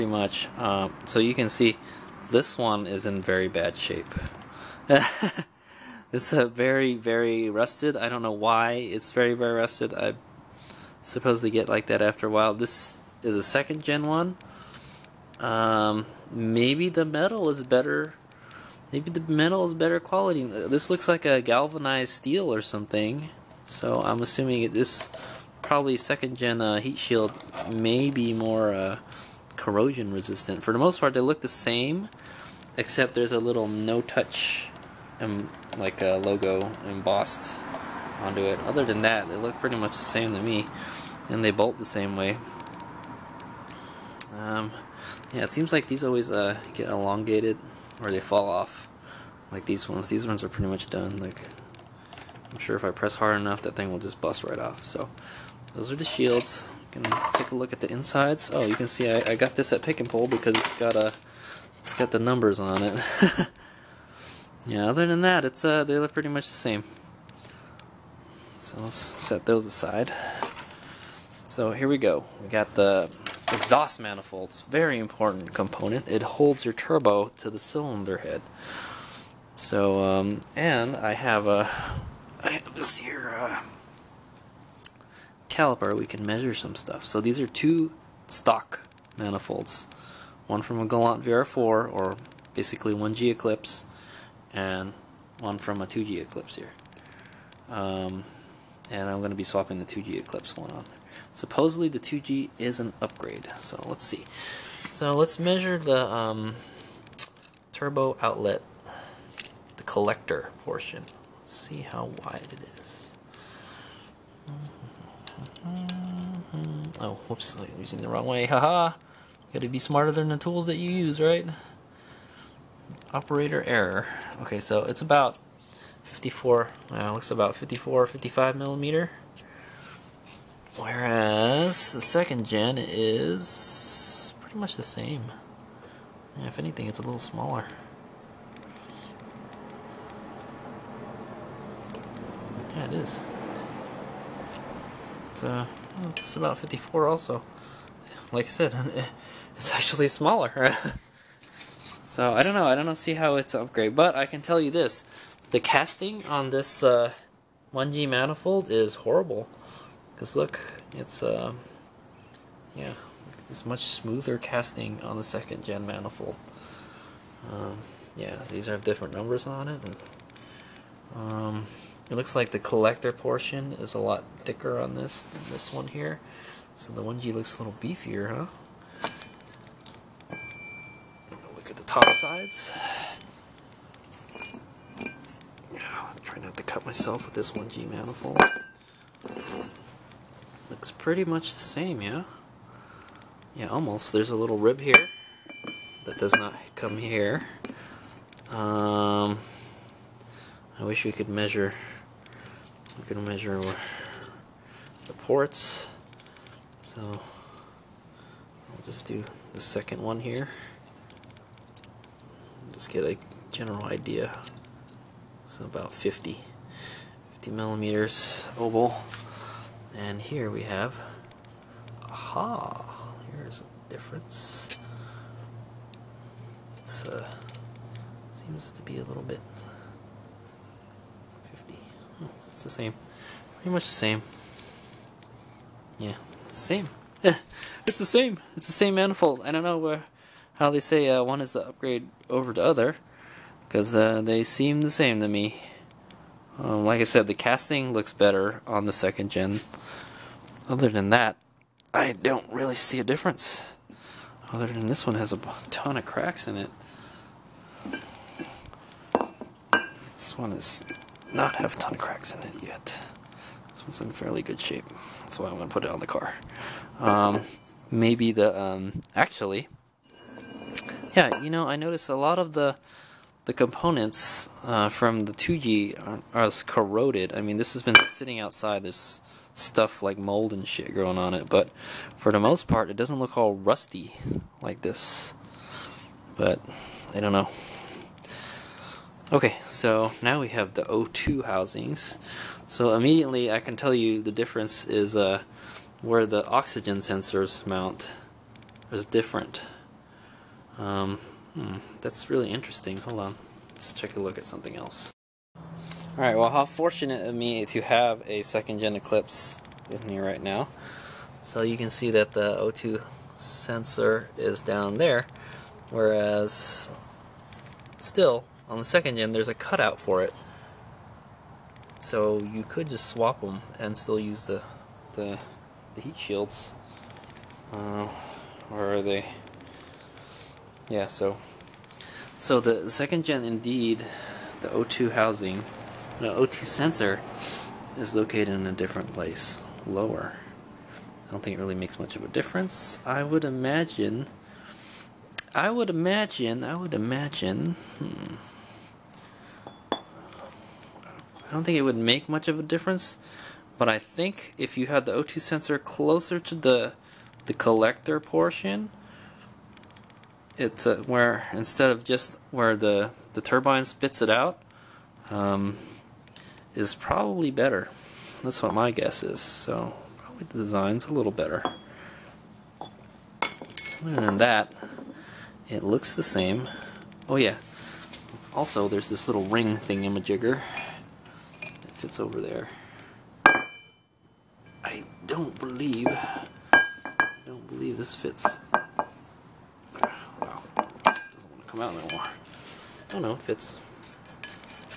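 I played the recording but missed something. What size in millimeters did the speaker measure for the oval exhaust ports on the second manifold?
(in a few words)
50 millimeters.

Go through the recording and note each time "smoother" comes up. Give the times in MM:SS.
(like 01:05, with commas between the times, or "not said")
02:43.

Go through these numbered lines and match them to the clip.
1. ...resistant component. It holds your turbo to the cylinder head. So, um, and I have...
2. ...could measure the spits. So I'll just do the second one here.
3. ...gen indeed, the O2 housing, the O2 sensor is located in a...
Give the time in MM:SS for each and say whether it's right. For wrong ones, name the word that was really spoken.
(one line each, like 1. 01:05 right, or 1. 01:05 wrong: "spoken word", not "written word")
1. 01:14 wrong: "important", not "resistant"
2. 03:23 wrong: "ports", not "spits"
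3. 05:33 right.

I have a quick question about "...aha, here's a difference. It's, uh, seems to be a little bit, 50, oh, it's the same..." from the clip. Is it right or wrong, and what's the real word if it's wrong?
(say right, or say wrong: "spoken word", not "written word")
right.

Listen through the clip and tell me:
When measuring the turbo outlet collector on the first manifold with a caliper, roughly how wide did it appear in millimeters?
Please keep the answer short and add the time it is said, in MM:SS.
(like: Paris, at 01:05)
54 to 55 millimeters, at 02:07.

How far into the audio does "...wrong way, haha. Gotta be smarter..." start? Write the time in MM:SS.
01:58.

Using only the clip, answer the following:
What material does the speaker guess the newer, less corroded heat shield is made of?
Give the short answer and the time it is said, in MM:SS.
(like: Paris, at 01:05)
Galvanized steel, at 00:21.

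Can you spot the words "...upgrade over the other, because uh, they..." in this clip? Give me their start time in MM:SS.
04:01.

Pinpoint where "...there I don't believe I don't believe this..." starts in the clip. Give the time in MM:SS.
06:22.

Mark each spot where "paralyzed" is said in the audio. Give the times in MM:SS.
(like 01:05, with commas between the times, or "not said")
not said.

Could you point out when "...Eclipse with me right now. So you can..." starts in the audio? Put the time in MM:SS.
05:08.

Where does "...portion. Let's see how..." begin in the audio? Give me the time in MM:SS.
01:50.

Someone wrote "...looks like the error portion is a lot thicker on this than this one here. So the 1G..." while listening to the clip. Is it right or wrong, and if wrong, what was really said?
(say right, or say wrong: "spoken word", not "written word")
wrong: "collector", not "error".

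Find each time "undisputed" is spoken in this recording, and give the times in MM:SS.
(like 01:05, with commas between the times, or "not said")
not said.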